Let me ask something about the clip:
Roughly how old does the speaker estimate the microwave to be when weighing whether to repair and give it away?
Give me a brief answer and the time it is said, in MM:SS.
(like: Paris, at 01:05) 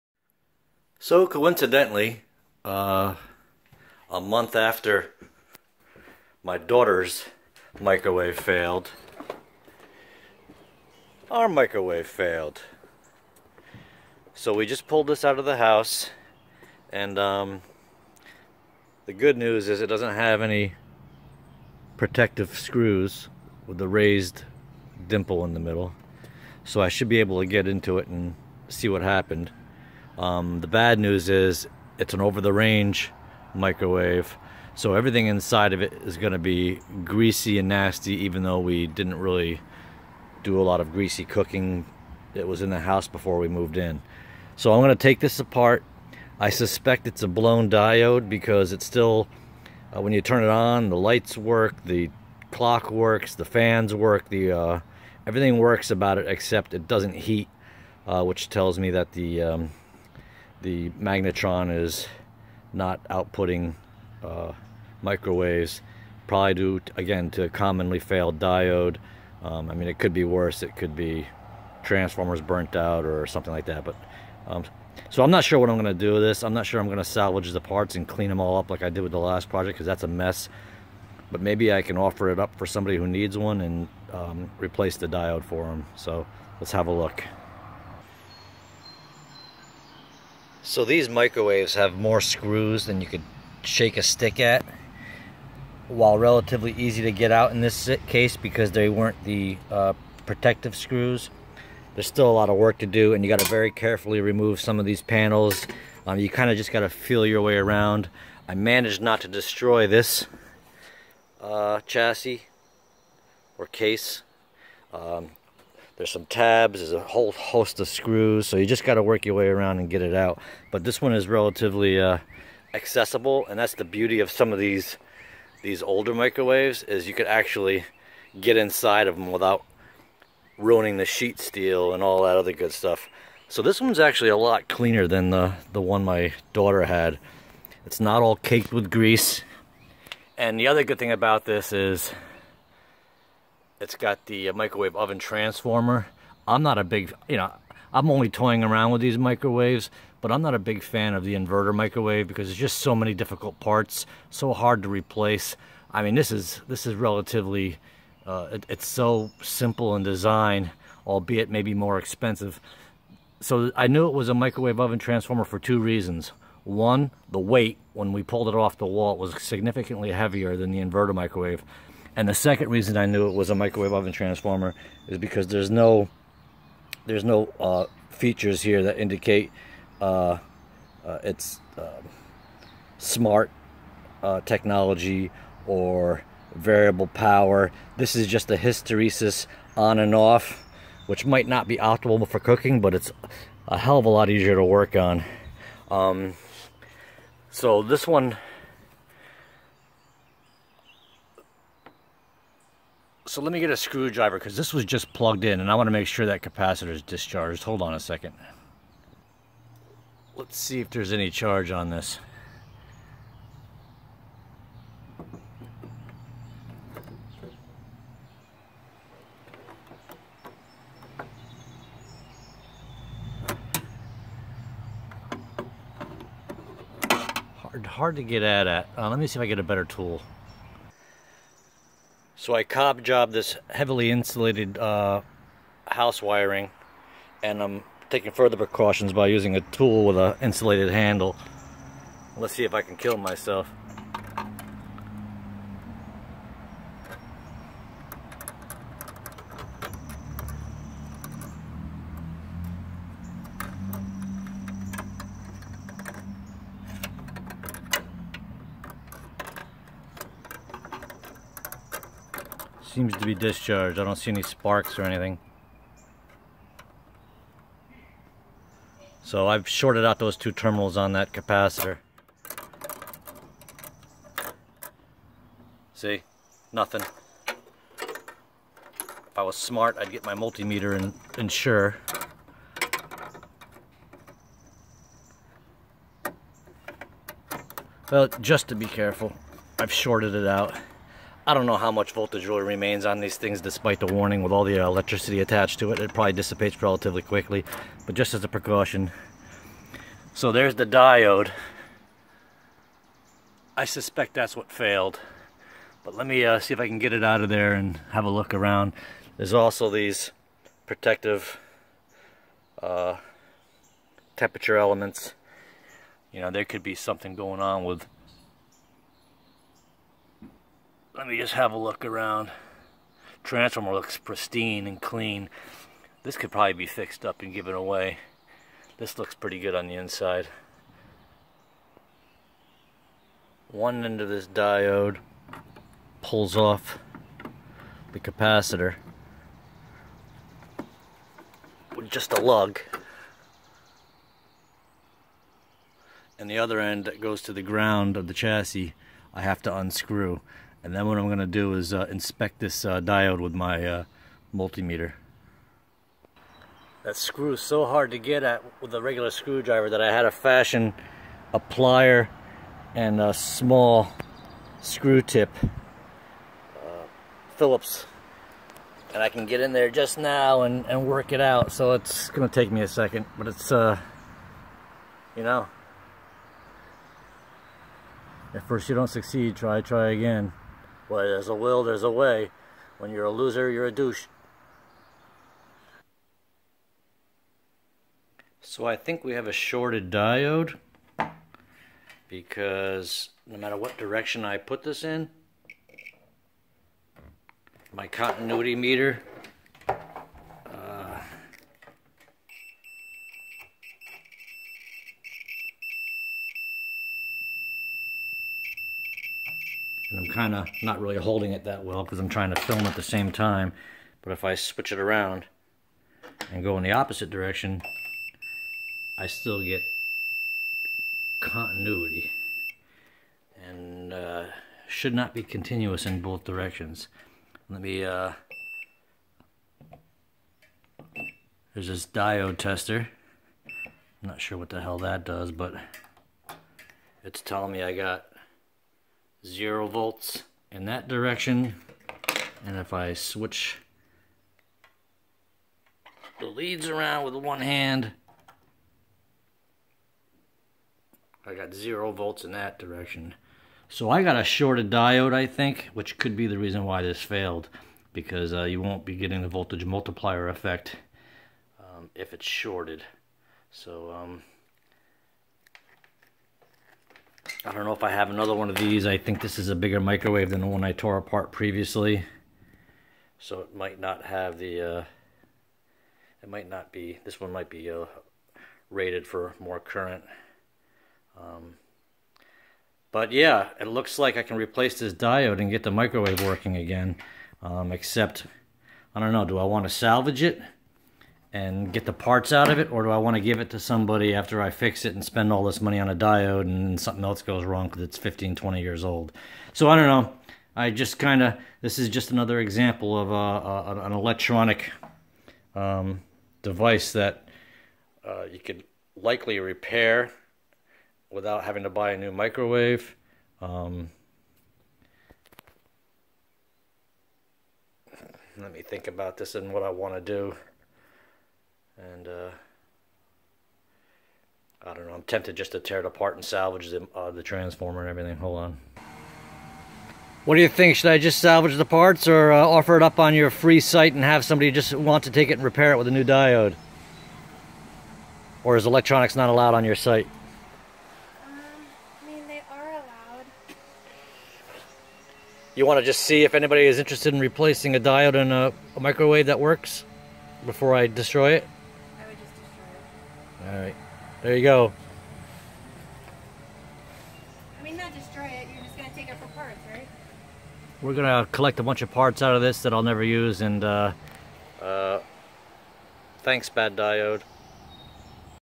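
15 to 20 years, at 08:18.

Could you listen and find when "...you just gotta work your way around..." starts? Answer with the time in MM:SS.
01:58.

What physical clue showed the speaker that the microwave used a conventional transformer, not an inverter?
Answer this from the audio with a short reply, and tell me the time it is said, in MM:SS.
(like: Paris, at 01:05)
the weight, at 02:47.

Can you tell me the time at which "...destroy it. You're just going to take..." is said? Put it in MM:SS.
09:18.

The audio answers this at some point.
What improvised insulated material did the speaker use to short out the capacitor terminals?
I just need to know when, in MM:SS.
03:55.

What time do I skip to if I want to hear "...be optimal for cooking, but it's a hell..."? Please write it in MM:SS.
03:11.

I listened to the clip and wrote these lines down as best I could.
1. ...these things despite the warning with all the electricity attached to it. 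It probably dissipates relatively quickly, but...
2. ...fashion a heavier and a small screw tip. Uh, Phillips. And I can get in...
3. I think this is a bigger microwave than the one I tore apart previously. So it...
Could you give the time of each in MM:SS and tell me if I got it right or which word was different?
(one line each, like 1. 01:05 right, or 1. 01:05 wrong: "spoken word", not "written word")
1. 04:53 right
2. 06:00 wrong: "plier", not "heavier"
3. 07:49 right.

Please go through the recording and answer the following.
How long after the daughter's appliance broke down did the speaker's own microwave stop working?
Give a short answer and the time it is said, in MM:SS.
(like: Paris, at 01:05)
a month, at 00:04.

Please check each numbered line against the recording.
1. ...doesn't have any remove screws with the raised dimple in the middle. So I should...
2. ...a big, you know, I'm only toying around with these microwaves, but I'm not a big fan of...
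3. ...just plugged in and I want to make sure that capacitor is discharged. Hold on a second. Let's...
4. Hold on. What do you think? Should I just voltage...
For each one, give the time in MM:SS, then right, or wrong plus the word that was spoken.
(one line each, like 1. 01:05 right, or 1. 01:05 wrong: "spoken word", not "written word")
1. 00:19 wrong: "protective", not "remove"
2. 02:26 right
3. 03:24 right
4. 08:48 wrong: "salvage", not "voltage".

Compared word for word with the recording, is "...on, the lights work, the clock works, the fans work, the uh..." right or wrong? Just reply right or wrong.
right.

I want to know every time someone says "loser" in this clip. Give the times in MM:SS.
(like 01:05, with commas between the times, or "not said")
06:23.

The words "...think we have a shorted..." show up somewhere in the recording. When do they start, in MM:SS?
06:28.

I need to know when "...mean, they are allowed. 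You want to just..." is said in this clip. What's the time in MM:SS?
09:02.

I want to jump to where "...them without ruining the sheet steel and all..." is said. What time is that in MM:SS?
02:09.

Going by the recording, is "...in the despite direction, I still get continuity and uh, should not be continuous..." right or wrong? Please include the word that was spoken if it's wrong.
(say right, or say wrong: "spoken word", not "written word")
wrong: "opposite", not "despite".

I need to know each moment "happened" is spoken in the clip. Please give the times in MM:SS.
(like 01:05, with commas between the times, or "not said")
00:29.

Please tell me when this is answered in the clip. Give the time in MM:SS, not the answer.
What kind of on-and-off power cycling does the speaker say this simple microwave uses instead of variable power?
03:08.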